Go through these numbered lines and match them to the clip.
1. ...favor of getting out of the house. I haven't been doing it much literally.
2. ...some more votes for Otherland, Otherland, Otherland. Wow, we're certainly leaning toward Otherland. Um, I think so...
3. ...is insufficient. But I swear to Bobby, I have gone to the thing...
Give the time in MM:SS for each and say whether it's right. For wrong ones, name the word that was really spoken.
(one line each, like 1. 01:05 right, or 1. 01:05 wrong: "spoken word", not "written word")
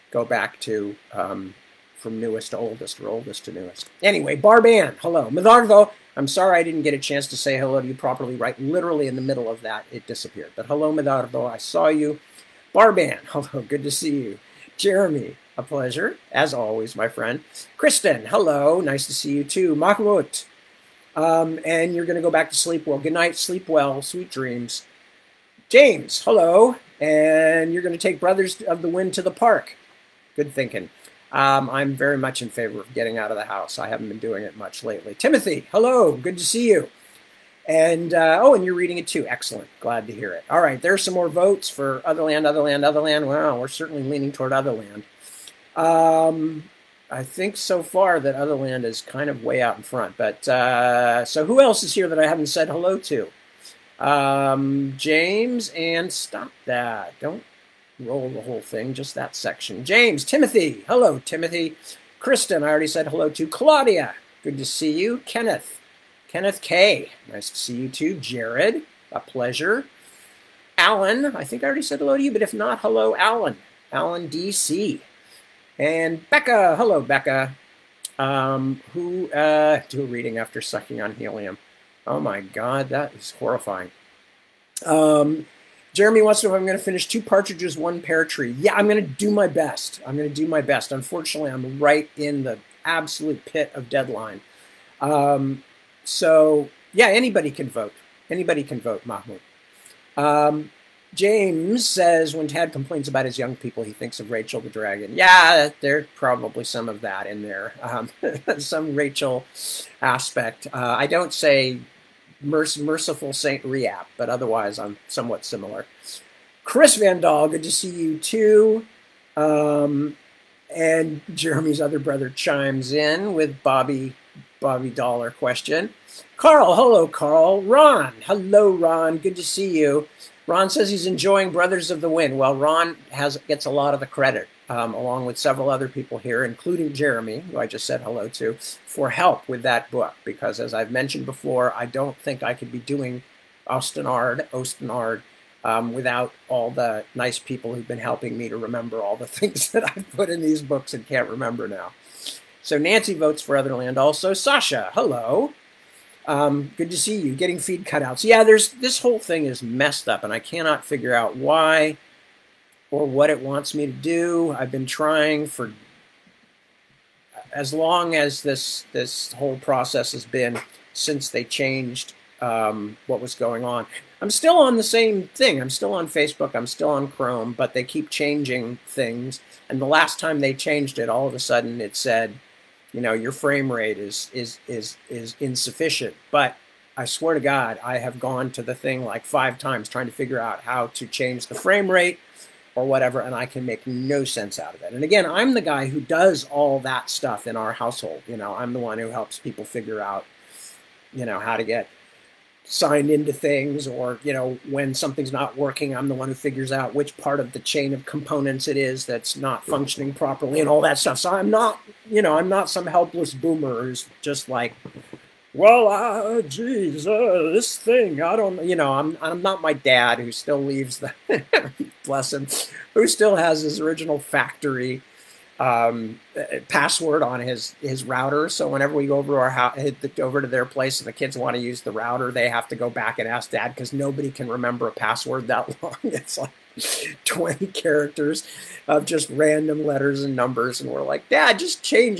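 1. 00:32 wrong: "lately", not "literally"
2. 00:41 right
3. 03:05 wrong: "God", not "Bobby".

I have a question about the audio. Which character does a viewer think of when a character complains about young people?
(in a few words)
Rachel the Dragon.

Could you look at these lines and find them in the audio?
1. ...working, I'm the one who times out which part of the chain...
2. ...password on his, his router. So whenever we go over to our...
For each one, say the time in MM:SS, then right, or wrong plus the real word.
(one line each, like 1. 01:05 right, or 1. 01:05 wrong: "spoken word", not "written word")
1. 03:25 wrong: "figures", not "times"
2. 03:46 right.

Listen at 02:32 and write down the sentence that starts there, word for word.
So Nancy votes for Otherland also.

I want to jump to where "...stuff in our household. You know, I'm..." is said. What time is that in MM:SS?
03:17.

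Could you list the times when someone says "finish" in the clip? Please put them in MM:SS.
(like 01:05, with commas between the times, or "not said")
01:26.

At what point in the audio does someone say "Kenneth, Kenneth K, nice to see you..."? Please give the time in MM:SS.
01:05.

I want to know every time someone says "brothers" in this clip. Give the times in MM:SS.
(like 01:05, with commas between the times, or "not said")
00:28, 02:01, 02:11.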